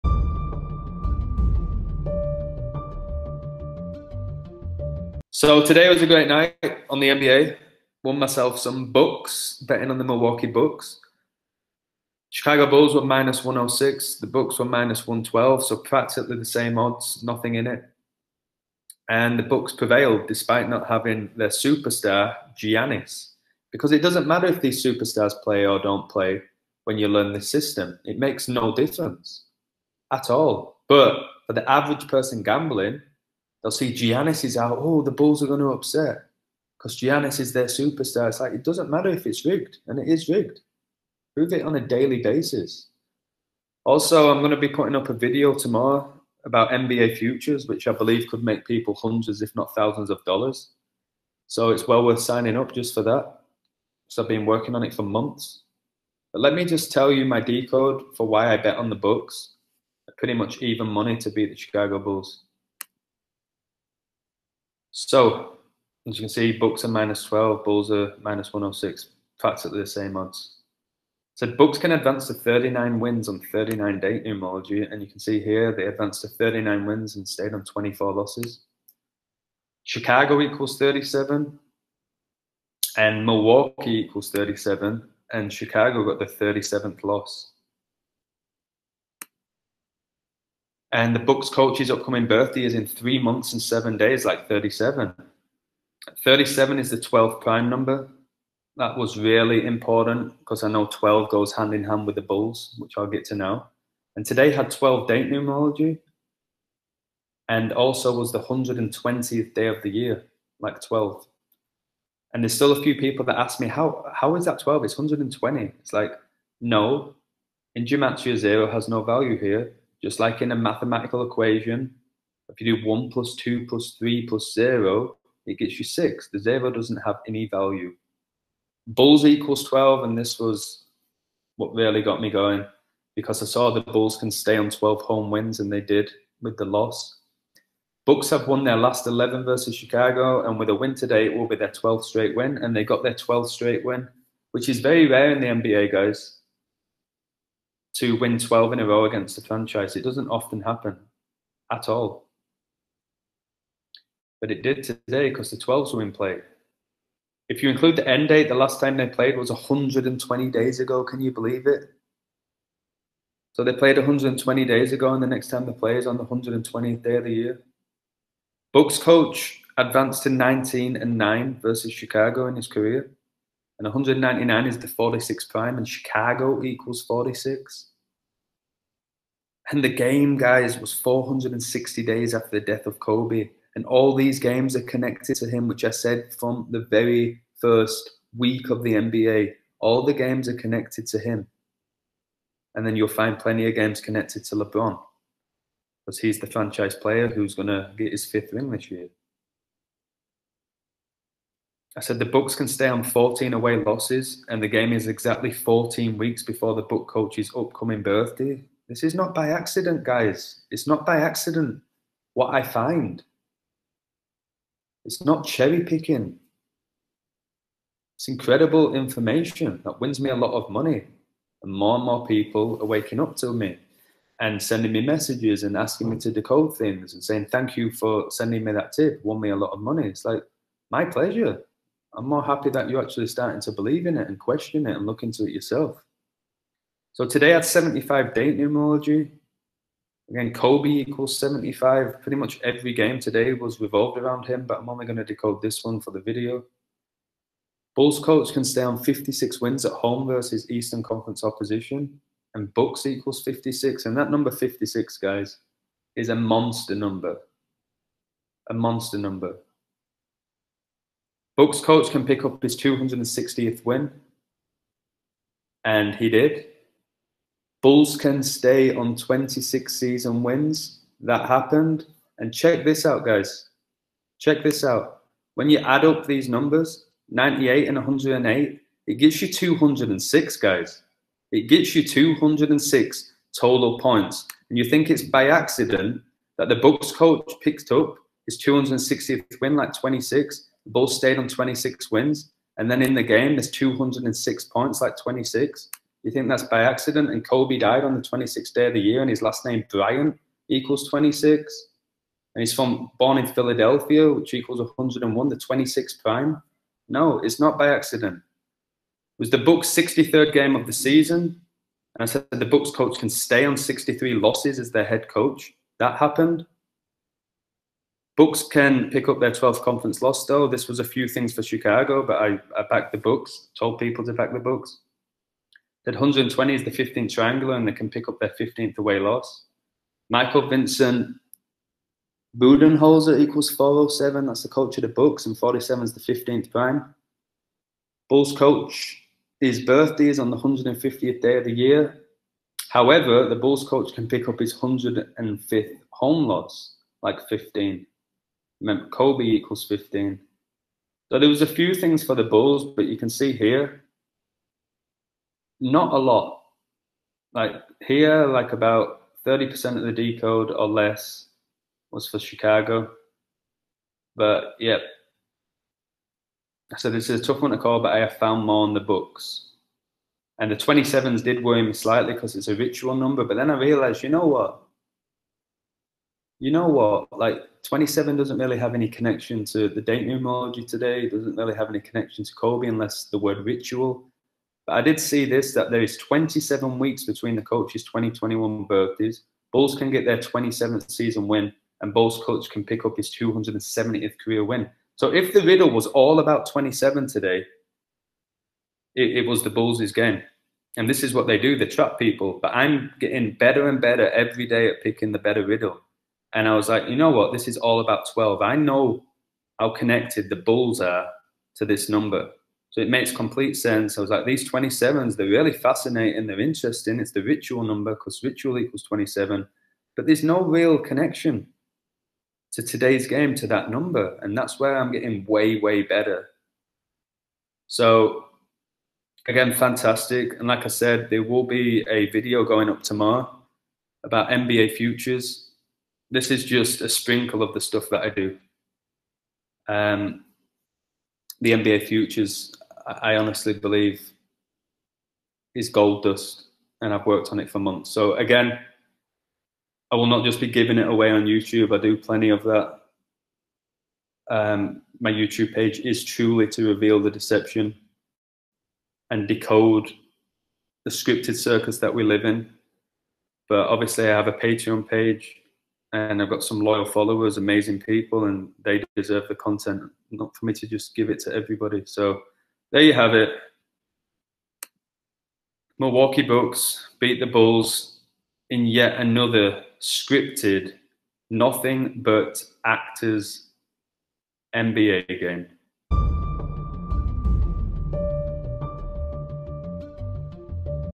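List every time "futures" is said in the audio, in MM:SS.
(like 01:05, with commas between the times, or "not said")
00:47, 07:14, 07:22.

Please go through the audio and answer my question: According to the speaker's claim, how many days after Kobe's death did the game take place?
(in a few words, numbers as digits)
460.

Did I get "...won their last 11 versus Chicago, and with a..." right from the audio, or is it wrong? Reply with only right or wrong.
right.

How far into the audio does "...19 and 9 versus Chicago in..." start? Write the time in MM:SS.
02:50.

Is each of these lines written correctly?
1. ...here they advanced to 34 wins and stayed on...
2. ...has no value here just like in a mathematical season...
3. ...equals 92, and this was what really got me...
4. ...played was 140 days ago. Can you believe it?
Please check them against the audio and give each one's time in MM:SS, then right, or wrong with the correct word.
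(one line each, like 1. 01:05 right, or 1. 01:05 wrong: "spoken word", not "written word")
1. 01:15 wrong: "39", not "34"
2. 01:58 wrong: "equation", not "season"
3. 02:09 wrong: "12", not "92"
4. 02:39 wrong: "120", not "140".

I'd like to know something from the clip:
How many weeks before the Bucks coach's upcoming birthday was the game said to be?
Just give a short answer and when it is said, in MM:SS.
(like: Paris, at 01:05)
14 weeks, at 03:25.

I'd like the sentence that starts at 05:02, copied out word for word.
And he's from born in Philadelphia, which equals 101, the 26th prime.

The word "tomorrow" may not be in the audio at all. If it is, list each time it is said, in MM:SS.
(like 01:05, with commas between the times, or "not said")
00:45, 07:13.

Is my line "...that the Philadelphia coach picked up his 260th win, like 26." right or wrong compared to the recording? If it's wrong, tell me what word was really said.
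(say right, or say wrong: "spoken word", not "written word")
wrong: "Bucks", not "Philadelphia".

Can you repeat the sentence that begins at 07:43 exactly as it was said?
But obviously, I have a Patreon page and I've got some loyal followers, amazing people, and they deserve the content.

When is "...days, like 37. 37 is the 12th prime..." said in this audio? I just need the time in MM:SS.
01:33.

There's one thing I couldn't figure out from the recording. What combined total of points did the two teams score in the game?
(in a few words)
206.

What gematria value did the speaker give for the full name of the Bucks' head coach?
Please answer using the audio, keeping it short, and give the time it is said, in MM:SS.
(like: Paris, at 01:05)
407, at 05:33.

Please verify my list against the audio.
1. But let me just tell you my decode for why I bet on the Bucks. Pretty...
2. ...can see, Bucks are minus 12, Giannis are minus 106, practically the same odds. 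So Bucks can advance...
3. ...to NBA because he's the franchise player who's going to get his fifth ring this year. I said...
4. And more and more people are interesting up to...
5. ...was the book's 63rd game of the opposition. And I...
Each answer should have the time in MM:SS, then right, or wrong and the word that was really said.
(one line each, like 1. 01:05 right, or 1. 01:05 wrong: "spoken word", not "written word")
1. 00:56 right
2. 01:06 wrong: "Bulls", not "Giannis"
3. 03:14 wrong: "LeBron", not "NBA"
4. 03:41 wrong: "waking", not "interesting"
5. 05:09 wrong: "season", not "opposition".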